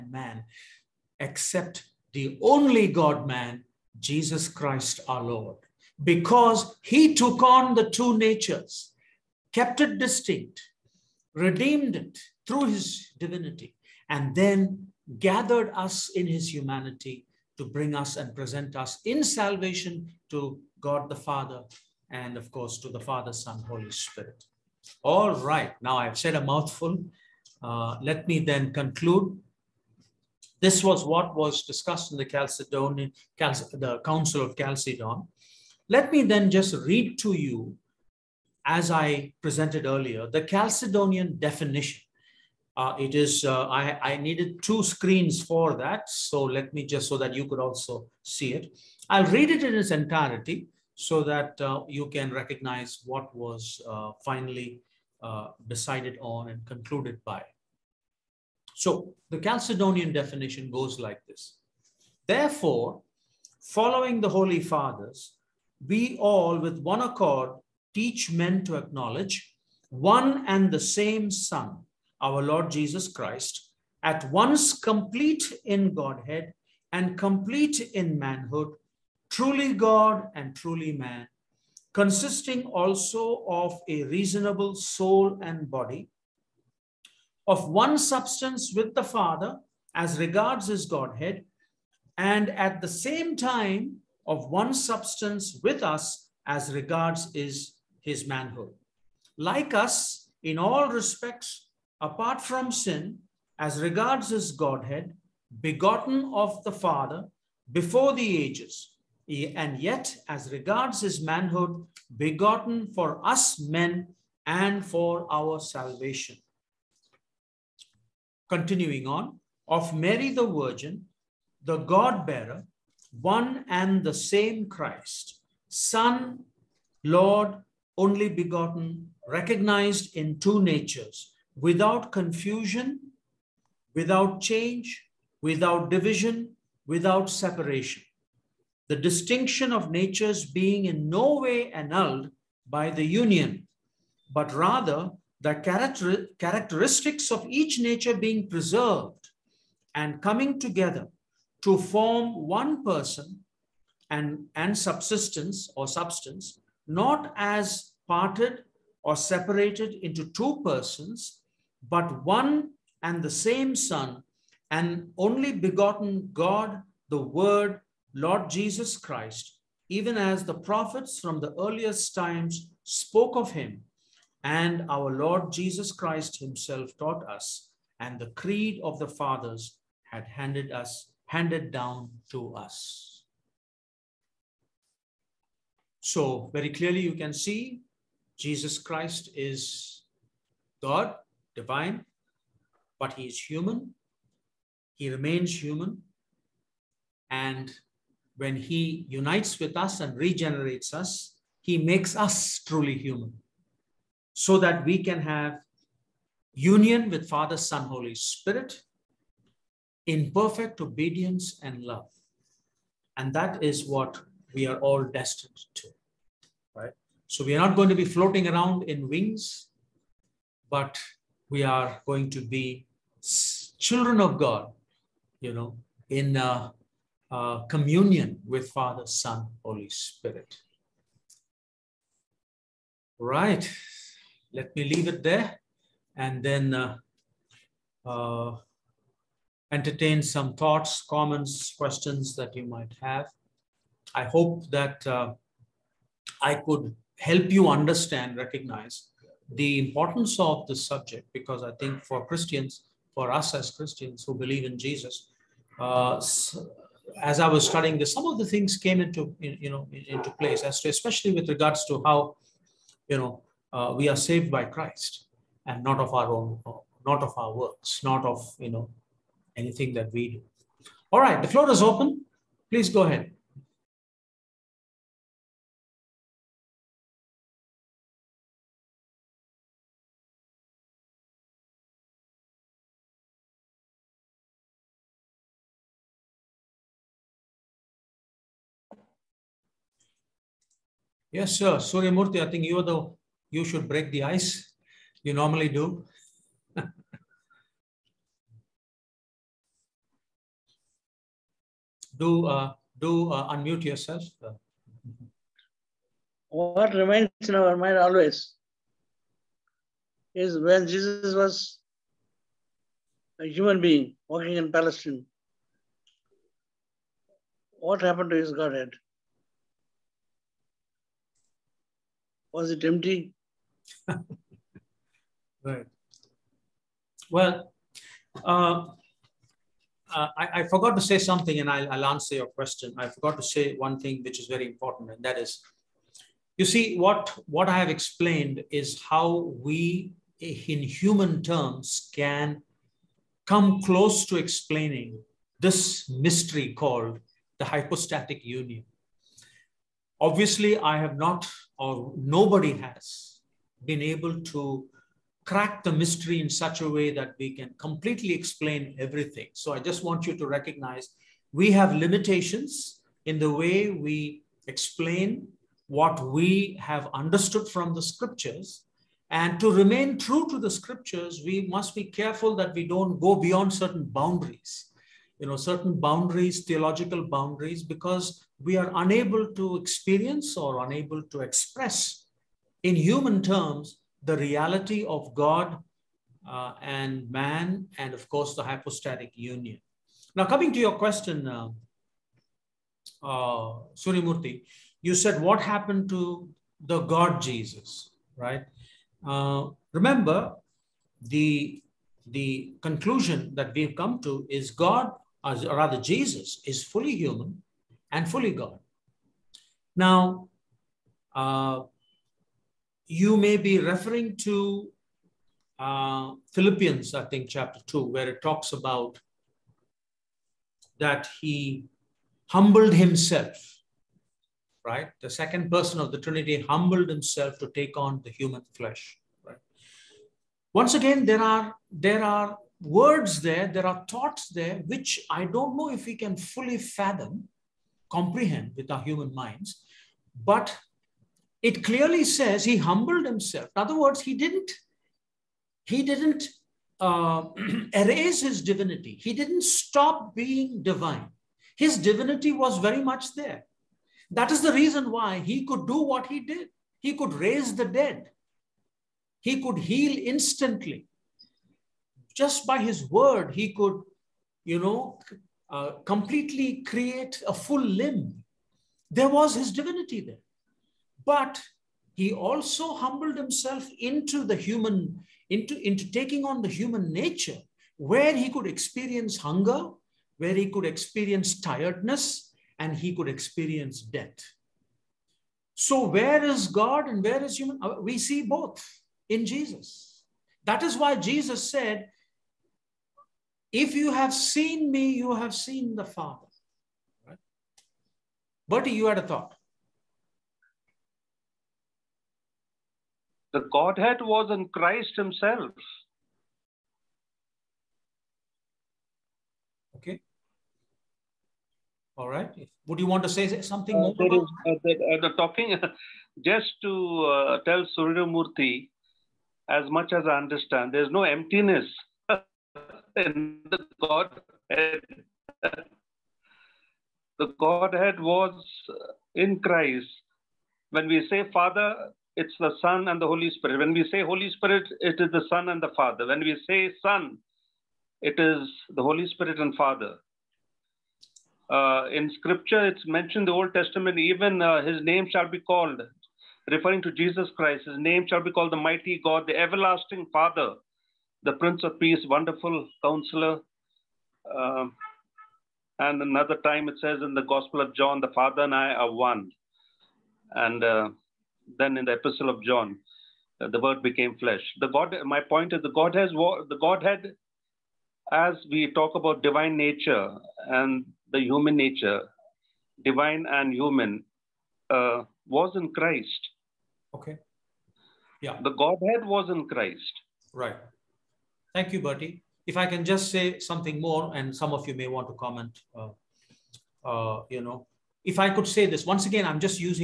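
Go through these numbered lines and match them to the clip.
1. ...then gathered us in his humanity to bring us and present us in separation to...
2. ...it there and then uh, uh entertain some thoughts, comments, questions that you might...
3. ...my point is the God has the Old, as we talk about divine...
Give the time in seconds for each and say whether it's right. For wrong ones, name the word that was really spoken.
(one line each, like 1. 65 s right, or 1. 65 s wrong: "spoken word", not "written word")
1. 14 s wrong: "salvation", not "separation"
2. 235 s right
3. 565 s wrong: "Godhead", not "Old".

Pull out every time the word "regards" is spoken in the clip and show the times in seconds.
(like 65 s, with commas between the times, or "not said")
90 s, 96 s, 103 s, 110 s, 261 s.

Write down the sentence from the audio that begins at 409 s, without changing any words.
Now, uh, you may be referring to uh, Philippians, I think, chapter 2, where it talks about that he humbled himself, right?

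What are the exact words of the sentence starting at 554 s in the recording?
Uh, and another time it says in the Gospel of John, the Father and I are one.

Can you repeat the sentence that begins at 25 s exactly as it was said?
All right, now I've said a mouthful.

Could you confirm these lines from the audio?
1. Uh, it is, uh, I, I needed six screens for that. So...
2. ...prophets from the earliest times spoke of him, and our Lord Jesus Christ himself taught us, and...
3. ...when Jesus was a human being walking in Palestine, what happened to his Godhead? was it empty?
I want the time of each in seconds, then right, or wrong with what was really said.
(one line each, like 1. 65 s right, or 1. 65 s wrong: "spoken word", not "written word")
1. 42 s wrong: "two", not "six"
2. 170 s right
3. 310 s right.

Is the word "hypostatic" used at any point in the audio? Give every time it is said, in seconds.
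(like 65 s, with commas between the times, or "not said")
347 s, 388 s.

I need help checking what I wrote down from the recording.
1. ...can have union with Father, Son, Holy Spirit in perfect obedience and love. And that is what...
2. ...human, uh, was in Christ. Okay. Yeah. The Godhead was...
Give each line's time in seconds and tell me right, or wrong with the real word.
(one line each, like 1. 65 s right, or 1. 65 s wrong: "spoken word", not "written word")
1. 205 s right
2. 573 s right.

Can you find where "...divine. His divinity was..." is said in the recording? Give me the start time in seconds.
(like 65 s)
450 s.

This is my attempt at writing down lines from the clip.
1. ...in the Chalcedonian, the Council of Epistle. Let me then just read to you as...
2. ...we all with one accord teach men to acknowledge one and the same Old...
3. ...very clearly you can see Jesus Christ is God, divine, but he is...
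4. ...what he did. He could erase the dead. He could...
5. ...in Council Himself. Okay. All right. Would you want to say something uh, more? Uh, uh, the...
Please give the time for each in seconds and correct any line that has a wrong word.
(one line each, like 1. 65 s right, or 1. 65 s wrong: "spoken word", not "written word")
1. 32 s wrong: "Chalcedon", not "Epistle"
2. 65 s wrong: "Son", not "Old"
3. 186 s right
4. 456 s wrong: "raise", not "erase"
5. 504 s wrong: "Christ", not "Council".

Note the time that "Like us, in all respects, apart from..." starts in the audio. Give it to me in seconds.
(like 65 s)
99 s.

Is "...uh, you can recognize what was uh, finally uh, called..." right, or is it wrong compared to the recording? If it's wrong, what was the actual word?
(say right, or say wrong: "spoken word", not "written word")
wrong: "decided", not "called".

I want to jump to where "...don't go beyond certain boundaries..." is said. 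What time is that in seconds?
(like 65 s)
372 s.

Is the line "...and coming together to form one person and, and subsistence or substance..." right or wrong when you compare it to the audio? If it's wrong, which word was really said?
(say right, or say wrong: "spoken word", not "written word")
right.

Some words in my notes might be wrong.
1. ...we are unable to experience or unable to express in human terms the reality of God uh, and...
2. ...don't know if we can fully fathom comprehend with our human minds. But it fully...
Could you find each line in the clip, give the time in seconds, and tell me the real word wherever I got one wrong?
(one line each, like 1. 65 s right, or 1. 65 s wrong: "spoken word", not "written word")
1. 378 s right
2. 435 s wrong: "clearly", not "fully".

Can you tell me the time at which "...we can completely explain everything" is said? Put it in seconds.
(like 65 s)
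357 s.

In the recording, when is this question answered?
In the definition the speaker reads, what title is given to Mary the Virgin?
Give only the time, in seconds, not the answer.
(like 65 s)
121 s.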